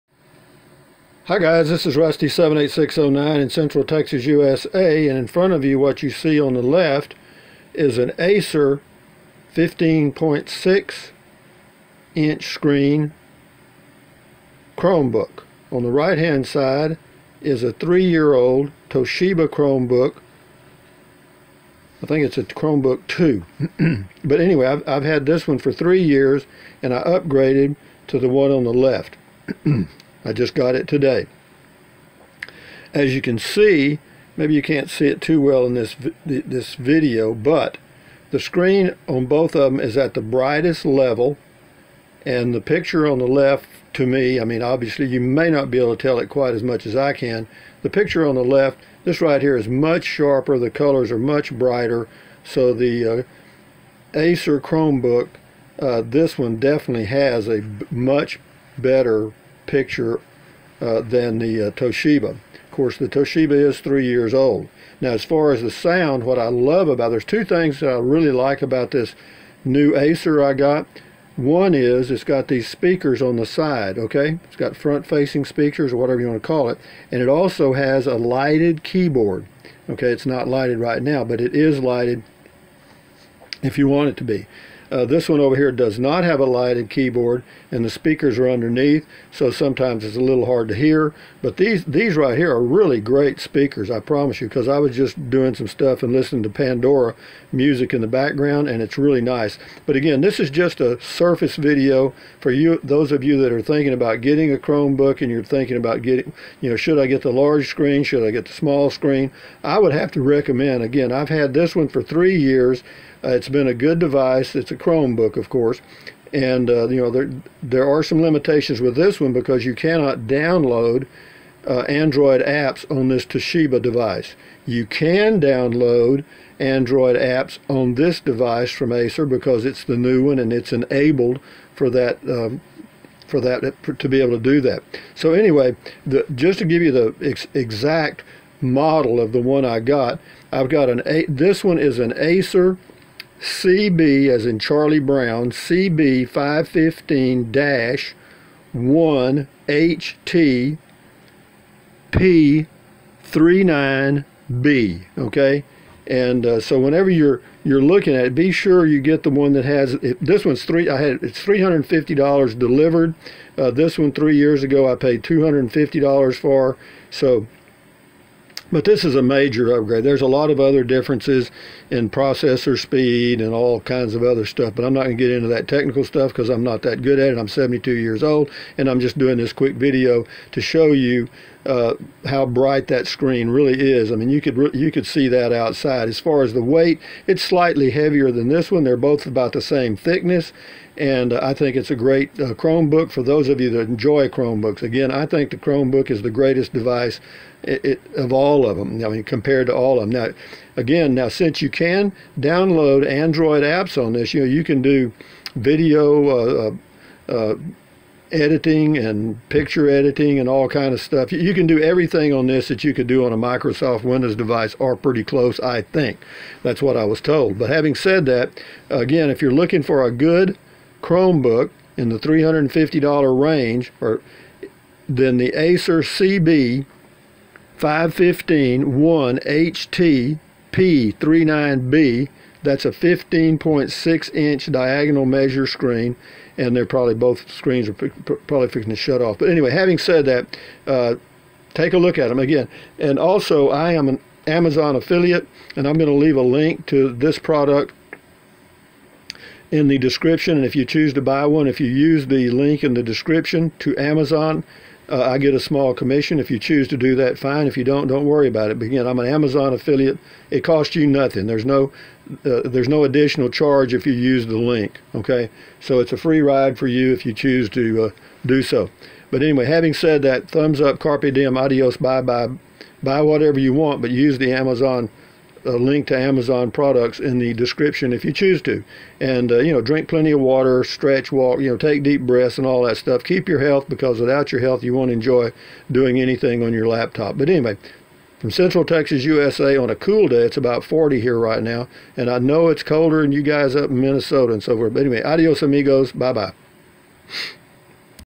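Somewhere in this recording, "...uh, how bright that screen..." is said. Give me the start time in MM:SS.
03:01.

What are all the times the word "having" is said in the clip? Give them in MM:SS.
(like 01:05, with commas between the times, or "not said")
03:37, 03:59, 04:29.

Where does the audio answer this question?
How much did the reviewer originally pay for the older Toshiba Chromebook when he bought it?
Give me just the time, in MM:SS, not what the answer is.
02:45.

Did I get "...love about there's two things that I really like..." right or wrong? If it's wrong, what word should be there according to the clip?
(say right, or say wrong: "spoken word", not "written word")
right.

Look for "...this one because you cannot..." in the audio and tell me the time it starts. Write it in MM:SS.
01:58.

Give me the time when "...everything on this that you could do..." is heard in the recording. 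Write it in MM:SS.
03:31.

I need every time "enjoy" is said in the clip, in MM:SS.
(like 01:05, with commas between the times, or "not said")
03:13, 04:45.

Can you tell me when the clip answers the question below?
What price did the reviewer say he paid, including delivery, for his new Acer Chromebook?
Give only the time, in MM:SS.
02:41.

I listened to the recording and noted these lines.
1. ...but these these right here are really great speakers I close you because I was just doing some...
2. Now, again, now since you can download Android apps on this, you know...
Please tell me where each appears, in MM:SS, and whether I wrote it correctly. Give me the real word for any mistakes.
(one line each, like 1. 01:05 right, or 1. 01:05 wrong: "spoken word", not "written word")
1. 01:31 wrong: "promise", not "close"
2. 03:20 right.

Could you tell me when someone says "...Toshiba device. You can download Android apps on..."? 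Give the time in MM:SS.
02:03.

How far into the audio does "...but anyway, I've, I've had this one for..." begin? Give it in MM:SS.
00:24.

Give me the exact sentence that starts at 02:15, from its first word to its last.
So anyway, the, just to give you the ex exact model of the one I got, I've got an A.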